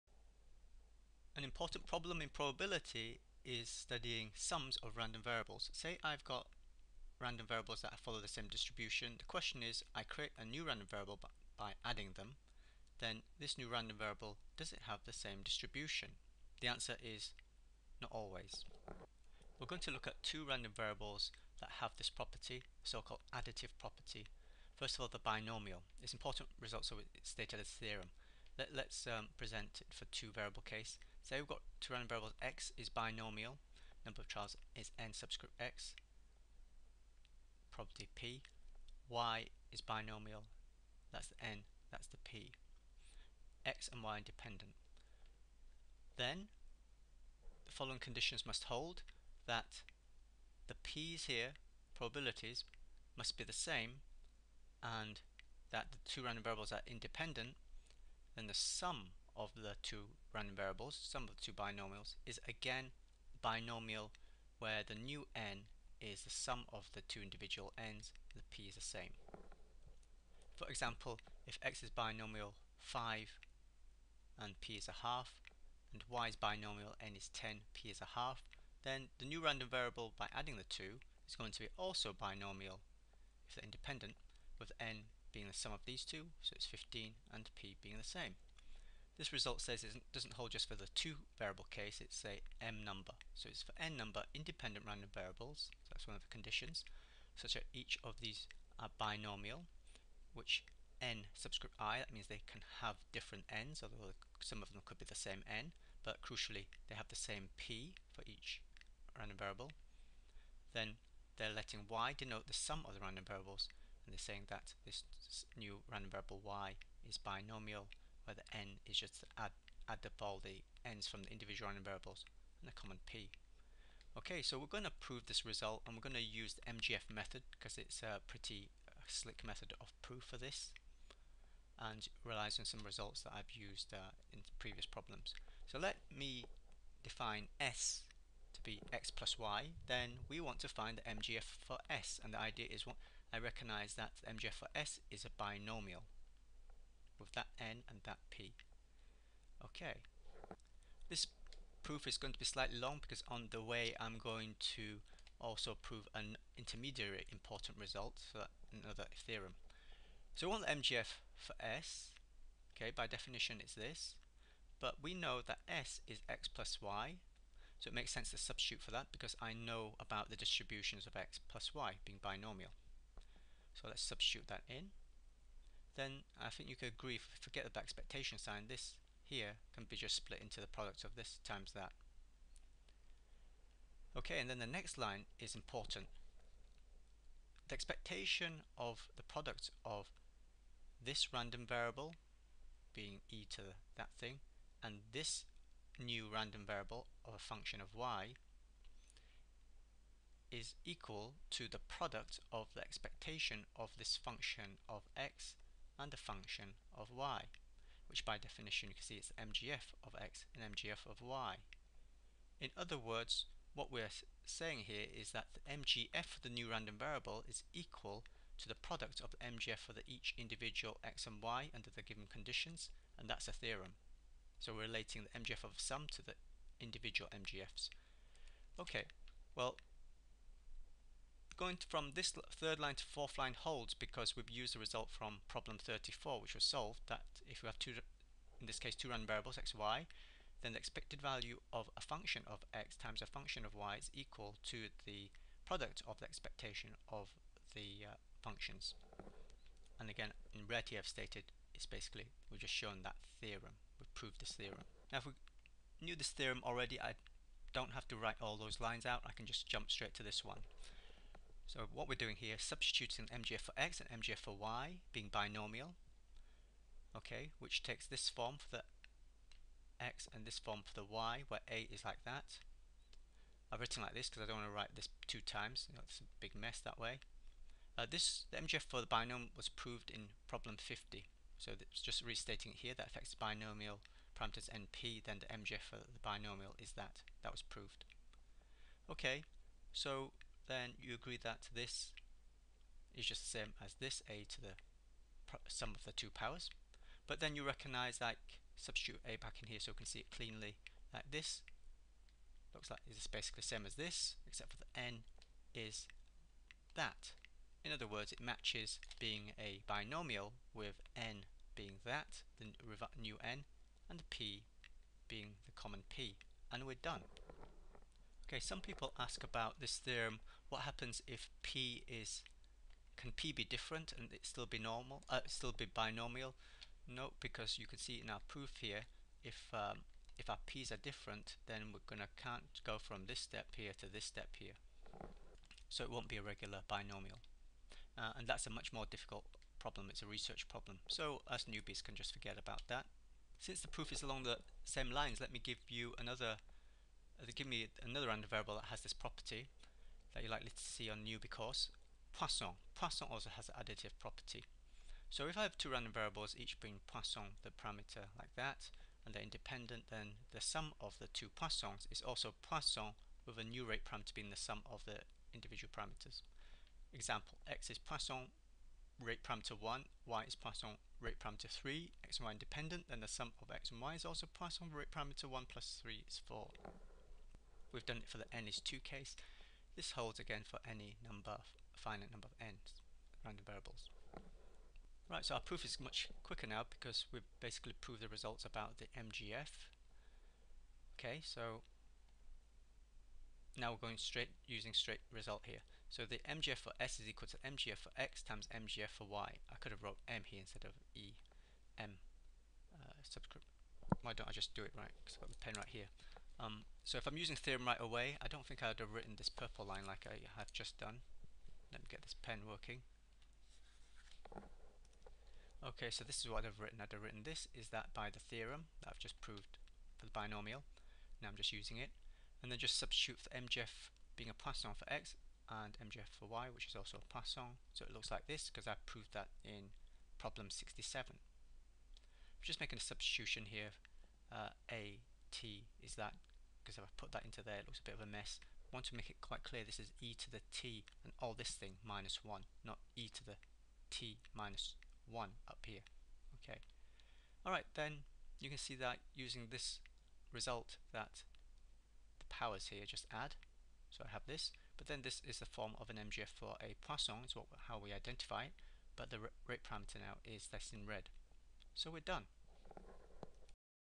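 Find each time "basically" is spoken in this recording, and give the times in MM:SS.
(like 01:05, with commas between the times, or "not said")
04:11, 05:03, 06:27.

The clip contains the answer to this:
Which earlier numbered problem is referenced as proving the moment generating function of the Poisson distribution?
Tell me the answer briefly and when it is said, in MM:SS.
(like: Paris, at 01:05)
Problem 67, at 07:10.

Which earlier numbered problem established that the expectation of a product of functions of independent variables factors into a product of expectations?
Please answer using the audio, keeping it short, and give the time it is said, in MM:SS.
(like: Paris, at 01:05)
Problem 34, at 03:55.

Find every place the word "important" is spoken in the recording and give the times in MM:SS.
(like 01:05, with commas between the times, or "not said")
00:01, 00:26, 02:37, 03:05.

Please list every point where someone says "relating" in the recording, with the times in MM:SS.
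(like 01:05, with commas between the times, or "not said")
03:44.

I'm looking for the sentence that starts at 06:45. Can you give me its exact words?
Because I've got the pen right here.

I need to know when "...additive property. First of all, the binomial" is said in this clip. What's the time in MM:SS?
00:23.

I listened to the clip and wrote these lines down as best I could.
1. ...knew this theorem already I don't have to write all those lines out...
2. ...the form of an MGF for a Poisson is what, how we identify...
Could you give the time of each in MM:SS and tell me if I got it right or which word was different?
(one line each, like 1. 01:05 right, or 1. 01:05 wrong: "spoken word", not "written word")
1. 04:16 right
2. 07:35 right.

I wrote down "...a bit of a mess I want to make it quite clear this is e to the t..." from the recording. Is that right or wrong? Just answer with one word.
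right.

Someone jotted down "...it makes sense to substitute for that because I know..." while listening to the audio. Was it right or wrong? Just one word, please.
right.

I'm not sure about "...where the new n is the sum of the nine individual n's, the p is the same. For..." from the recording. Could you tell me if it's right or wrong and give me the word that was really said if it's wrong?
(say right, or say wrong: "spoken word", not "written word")
wrong: "two", not "nine".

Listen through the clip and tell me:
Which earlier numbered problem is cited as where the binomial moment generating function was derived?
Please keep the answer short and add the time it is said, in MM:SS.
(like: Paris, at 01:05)
Problem 50, at 04:40.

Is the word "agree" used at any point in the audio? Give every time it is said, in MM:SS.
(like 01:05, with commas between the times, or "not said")
02:56, 04:51.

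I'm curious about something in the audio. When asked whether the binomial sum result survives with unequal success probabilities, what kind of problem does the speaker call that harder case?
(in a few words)
A research problem.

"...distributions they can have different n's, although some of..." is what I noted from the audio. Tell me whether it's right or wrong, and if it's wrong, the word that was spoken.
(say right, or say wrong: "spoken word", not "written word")
wrong: "means", not "distributions".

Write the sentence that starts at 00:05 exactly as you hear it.
Say I've got random variables that follow the same distribution.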